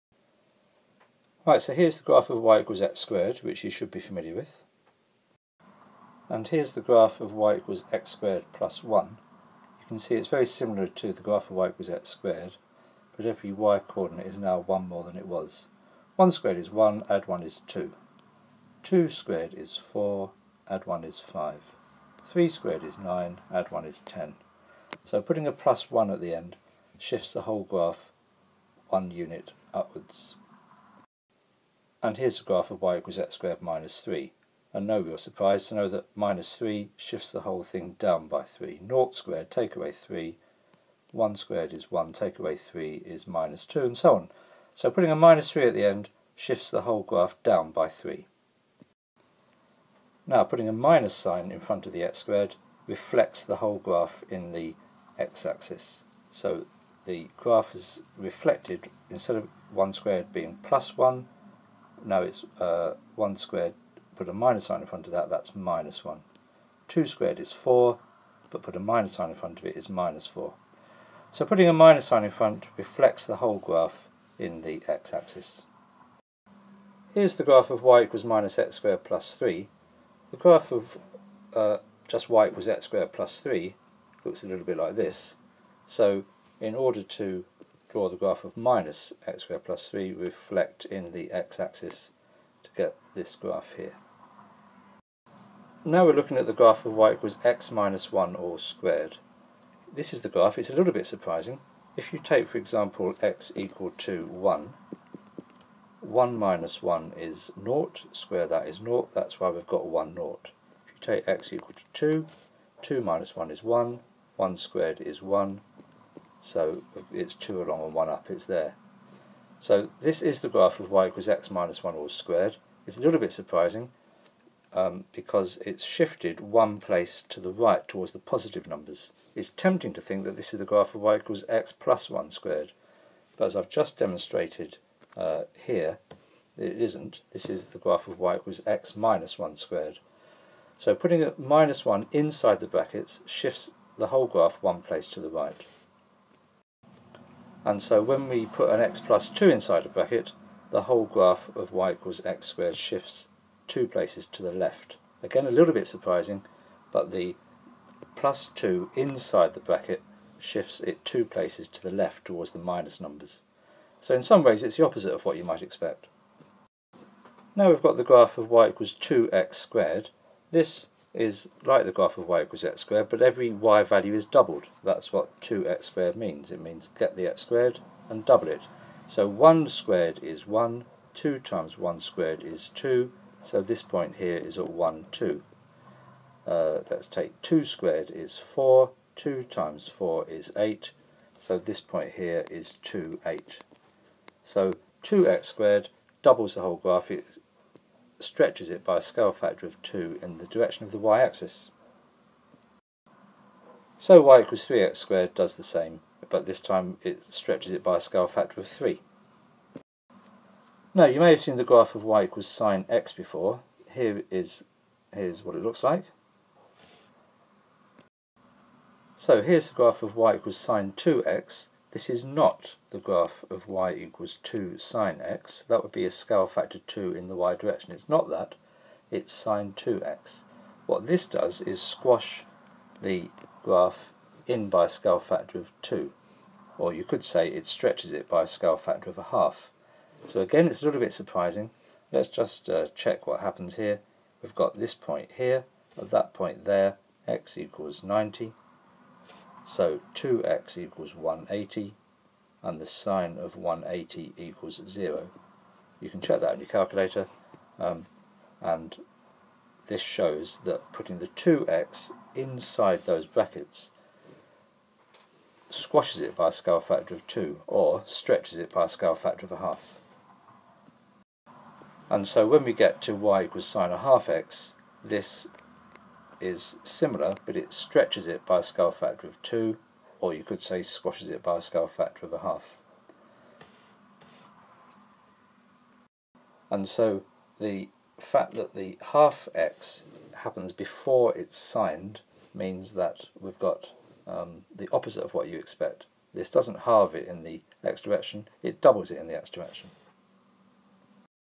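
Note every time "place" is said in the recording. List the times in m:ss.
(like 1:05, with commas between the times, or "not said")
2:06, 2:24, 2:33, 2:41.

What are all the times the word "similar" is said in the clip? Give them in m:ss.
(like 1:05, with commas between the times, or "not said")
0:10, 4:36.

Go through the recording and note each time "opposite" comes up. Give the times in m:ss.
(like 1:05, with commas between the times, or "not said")
2:44, 4:54.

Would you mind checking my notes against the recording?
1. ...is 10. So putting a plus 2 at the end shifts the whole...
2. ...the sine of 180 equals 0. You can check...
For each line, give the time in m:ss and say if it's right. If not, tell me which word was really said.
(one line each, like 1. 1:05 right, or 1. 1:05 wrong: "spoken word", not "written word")
1. 0:23 wrong: "1", not "2"
2. 4:12 right.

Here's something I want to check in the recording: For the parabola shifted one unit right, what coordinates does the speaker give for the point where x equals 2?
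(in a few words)
2 along and 1 up.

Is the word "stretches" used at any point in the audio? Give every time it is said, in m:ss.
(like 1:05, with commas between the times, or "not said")
3:18, 3:27, 3:57, 4:28, 4:37.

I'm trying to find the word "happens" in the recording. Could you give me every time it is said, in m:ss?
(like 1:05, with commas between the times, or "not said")
4:03, 4:50.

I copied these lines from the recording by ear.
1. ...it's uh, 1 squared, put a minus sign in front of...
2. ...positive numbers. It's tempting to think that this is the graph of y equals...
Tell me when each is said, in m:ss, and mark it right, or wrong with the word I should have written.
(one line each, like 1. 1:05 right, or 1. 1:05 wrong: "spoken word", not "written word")
1. 1:02 right
2. 2:08 right.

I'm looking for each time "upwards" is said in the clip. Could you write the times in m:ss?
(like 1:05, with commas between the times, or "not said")
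0:29.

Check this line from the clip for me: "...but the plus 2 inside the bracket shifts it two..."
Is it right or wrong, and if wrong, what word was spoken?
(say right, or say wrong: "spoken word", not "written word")
right.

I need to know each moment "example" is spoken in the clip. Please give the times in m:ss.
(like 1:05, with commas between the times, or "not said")
1:42.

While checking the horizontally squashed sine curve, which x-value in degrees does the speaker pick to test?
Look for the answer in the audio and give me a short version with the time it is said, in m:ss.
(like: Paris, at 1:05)
90, at 4:07.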